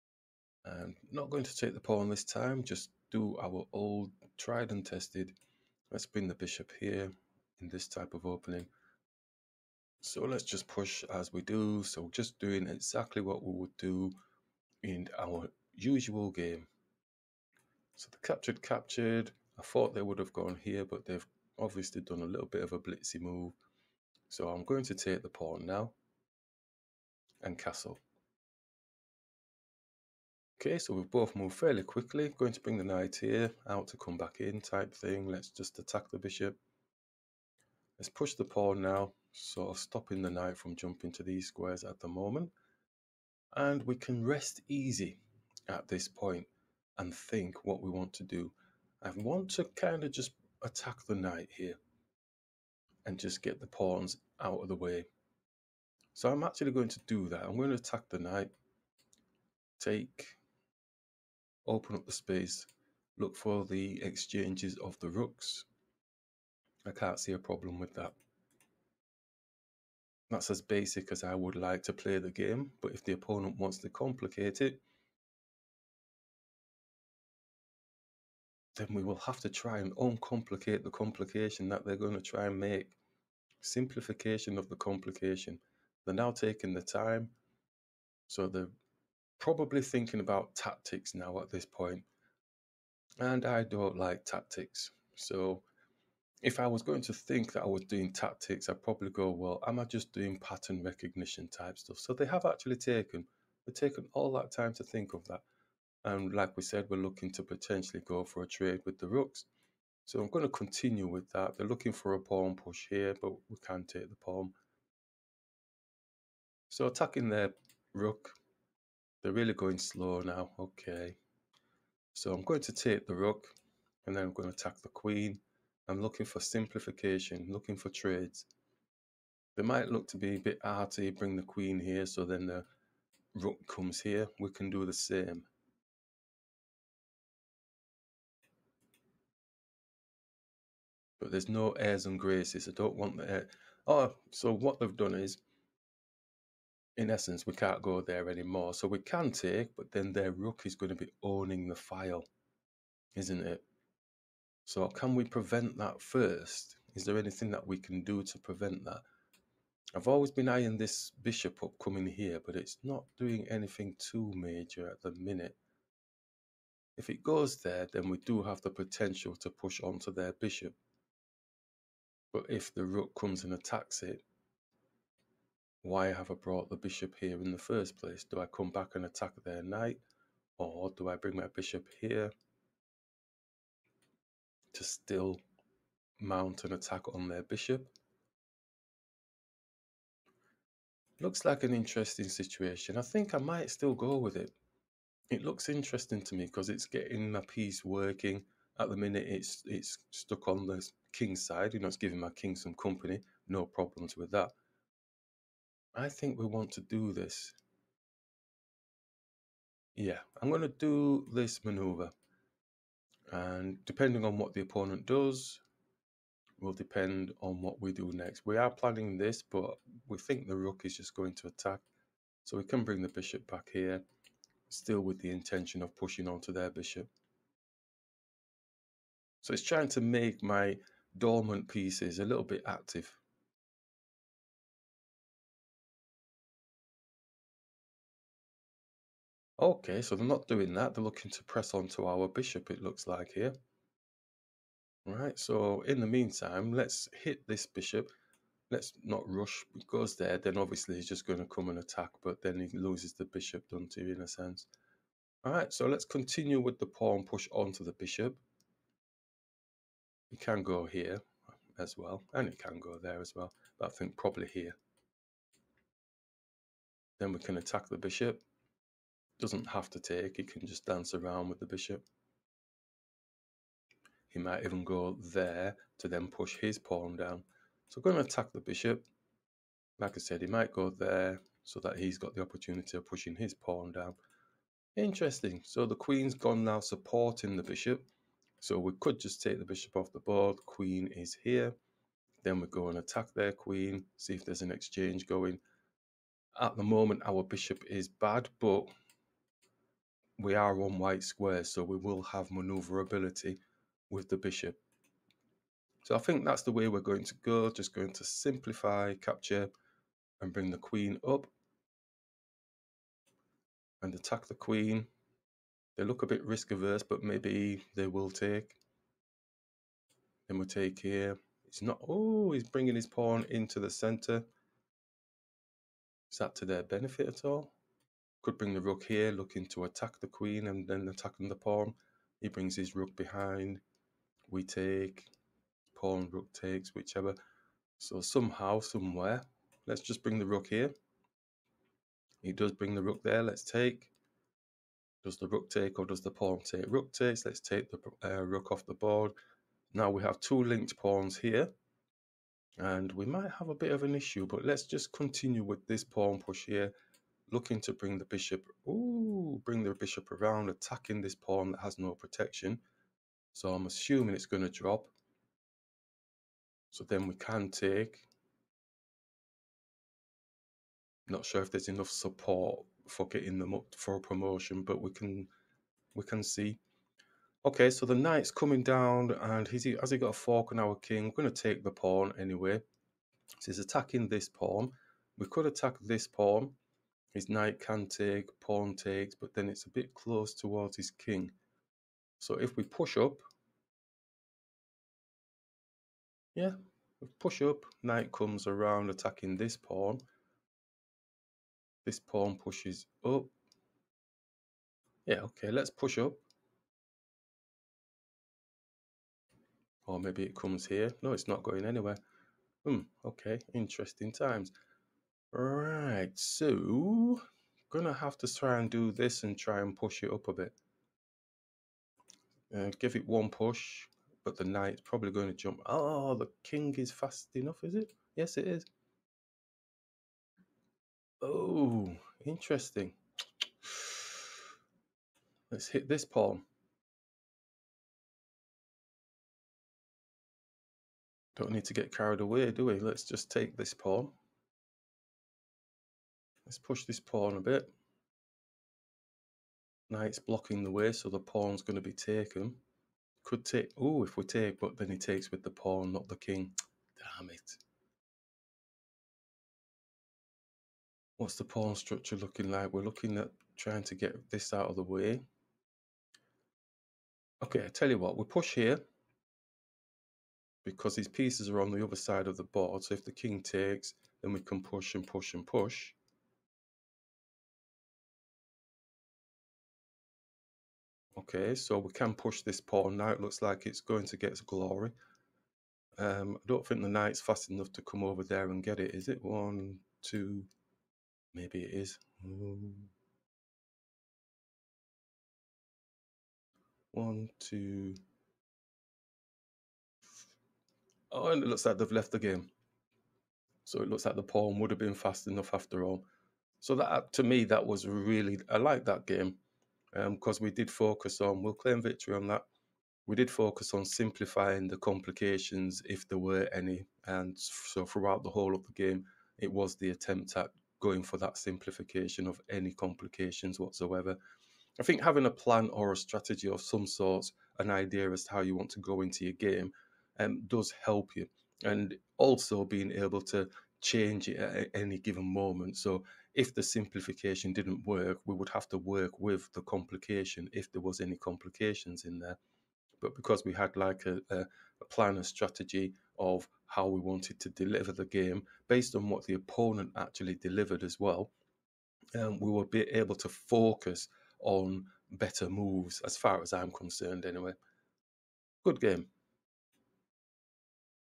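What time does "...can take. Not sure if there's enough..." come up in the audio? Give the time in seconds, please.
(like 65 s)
367 s.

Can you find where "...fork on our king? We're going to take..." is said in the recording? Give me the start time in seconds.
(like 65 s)
380 s.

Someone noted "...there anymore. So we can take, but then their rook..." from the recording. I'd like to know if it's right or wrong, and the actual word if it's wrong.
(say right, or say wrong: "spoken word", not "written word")
right.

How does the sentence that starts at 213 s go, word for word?
And depending on what the opponent does, will depend on what we do next.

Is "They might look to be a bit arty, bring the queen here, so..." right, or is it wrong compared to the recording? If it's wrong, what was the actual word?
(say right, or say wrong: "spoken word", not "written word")
right.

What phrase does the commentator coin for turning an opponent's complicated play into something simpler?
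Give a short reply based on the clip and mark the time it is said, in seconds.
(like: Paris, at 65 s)
Simplification of the complication, at 83 s.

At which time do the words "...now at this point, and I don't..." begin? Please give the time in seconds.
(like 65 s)
91 s.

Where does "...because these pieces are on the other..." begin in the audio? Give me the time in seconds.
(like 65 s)
470 s.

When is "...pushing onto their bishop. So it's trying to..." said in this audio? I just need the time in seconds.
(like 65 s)
225 s.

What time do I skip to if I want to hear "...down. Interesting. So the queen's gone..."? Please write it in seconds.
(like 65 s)
283 s.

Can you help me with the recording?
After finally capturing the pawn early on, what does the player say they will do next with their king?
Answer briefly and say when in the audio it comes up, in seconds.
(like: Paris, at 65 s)
Castle, at 27 s.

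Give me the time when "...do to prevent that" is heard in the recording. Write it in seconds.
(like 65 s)
158 s.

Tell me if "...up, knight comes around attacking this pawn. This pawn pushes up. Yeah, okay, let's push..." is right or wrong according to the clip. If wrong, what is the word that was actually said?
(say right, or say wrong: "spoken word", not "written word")
right.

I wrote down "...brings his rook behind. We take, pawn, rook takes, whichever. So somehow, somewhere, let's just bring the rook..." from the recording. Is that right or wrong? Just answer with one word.
right.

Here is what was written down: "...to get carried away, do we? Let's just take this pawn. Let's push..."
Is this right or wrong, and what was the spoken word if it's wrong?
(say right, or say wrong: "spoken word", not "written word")
right.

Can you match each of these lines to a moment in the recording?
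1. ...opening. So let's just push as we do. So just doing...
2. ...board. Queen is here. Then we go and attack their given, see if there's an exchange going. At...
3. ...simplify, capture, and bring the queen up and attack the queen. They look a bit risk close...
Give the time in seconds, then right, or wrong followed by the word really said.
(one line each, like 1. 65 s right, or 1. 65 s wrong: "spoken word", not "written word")
1. 8 s right
2. 290 s wrong: "queen", not "given"
3. 308 s wrong: "averse", not "close".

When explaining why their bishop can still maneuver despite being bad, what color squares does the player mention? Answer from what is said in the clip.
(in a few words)
White squares.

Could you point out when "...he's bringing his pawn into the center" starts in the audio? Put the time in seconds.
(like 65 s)
322 s.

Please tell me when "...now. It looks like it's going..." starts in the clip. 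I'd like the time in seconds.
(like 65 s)
483 s.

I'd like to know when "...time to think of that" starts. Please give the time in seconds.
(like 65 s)
104 s.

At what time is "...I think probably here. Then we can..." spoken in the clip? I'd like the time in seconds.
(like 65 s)
263 s.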